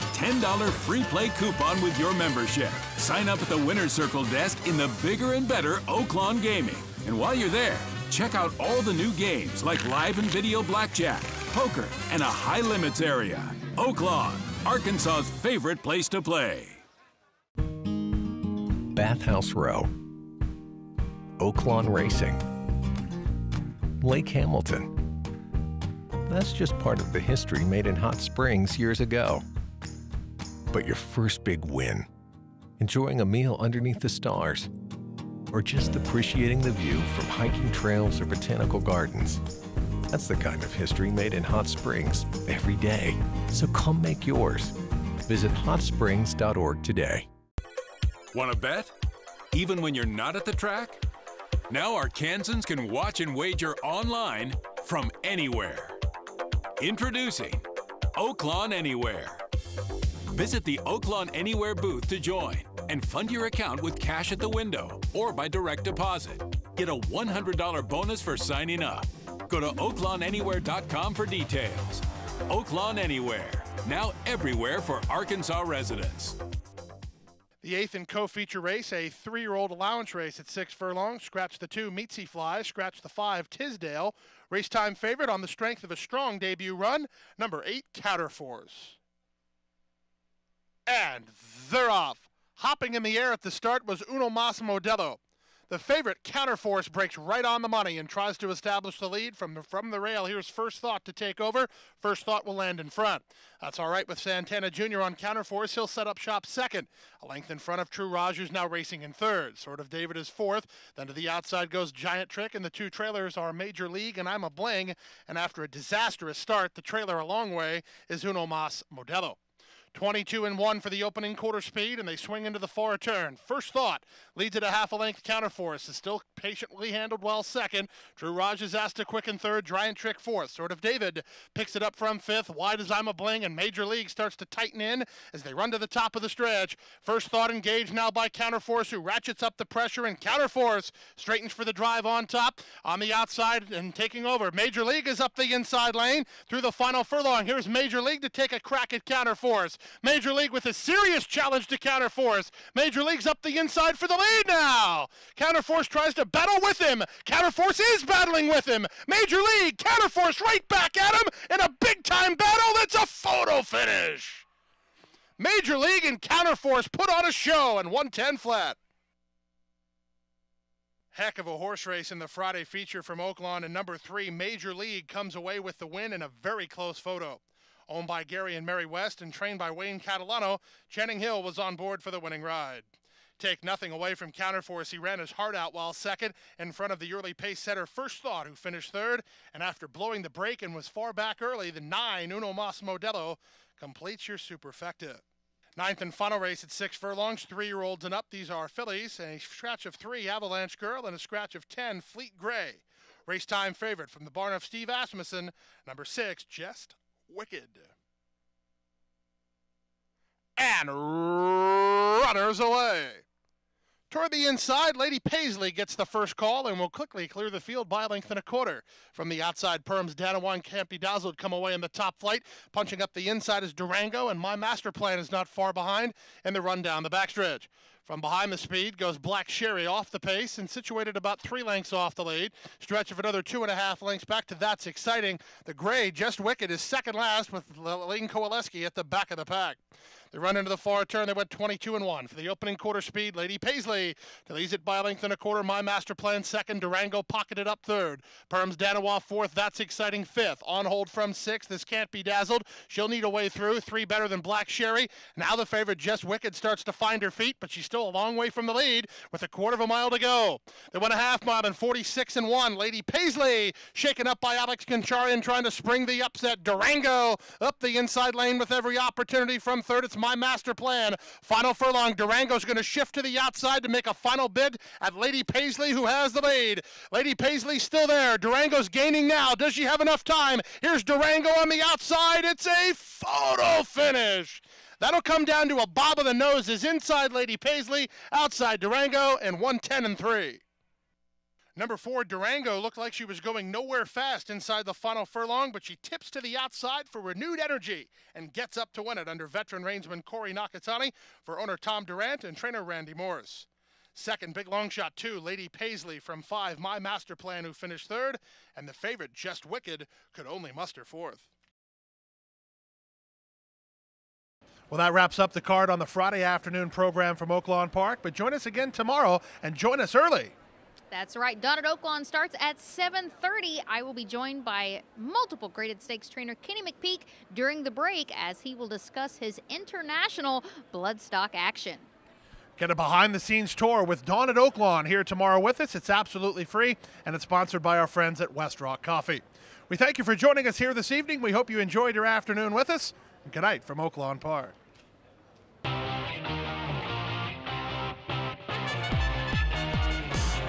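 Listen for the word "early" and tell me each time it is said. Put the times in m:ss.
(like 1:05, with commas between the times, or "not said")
3:07, 3:11, 5:20.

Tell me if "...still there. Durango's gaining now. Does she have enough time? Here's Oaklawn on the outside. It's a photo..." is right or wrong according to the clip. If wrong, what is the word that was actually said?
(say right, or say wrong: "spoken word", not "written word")
wrong: "Durango", not "Oaklawn".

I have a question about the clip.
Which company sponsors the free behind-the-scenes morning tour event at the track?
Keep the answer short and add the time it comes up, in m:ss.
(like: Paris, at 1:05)
West Rock Coffee, at 5:38.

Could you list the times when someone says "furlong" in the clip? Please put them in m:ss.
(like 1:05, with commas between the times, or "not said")
1:20, 2:27, 3:16, 4:31, 4:55.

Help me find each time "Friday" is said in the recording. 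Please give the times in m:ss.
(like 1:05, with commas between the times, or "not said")
2:52, 5:16.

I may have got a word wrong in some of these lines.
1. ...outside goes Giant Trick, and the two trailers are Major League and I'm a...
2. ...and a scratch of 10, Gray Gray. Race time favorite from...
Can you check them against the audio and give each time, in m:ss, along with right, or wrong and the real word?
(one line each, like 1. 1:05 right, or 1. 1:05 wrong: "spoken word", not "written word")
1. 1:51 right
2. 3:21 wrong: "Fleet", not "Gray".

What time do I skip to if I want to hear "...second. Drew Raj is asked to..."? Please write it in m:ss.
2:07.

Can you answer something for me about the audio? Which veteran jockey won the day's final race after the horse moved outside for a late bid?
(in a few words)
Corey Nakatani.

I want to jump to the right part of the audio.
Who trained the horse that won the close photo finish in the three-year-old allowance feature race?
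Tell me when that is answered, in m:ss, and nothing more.
2:59.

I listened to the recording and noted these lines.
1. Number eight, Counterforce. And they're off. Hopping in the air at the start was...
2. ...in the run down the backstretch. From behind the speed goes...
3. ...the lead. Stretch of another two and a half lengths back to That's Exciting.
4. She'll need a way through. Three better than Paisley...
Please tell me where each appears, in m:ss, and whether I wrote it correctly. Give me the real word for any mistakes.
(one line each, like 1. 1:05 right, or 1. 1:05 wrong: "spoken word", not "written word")
1. 1:27 right
2. 3:46 right
3. 3:52 right
4. 4:12 wrong: "Black", not "Paisley".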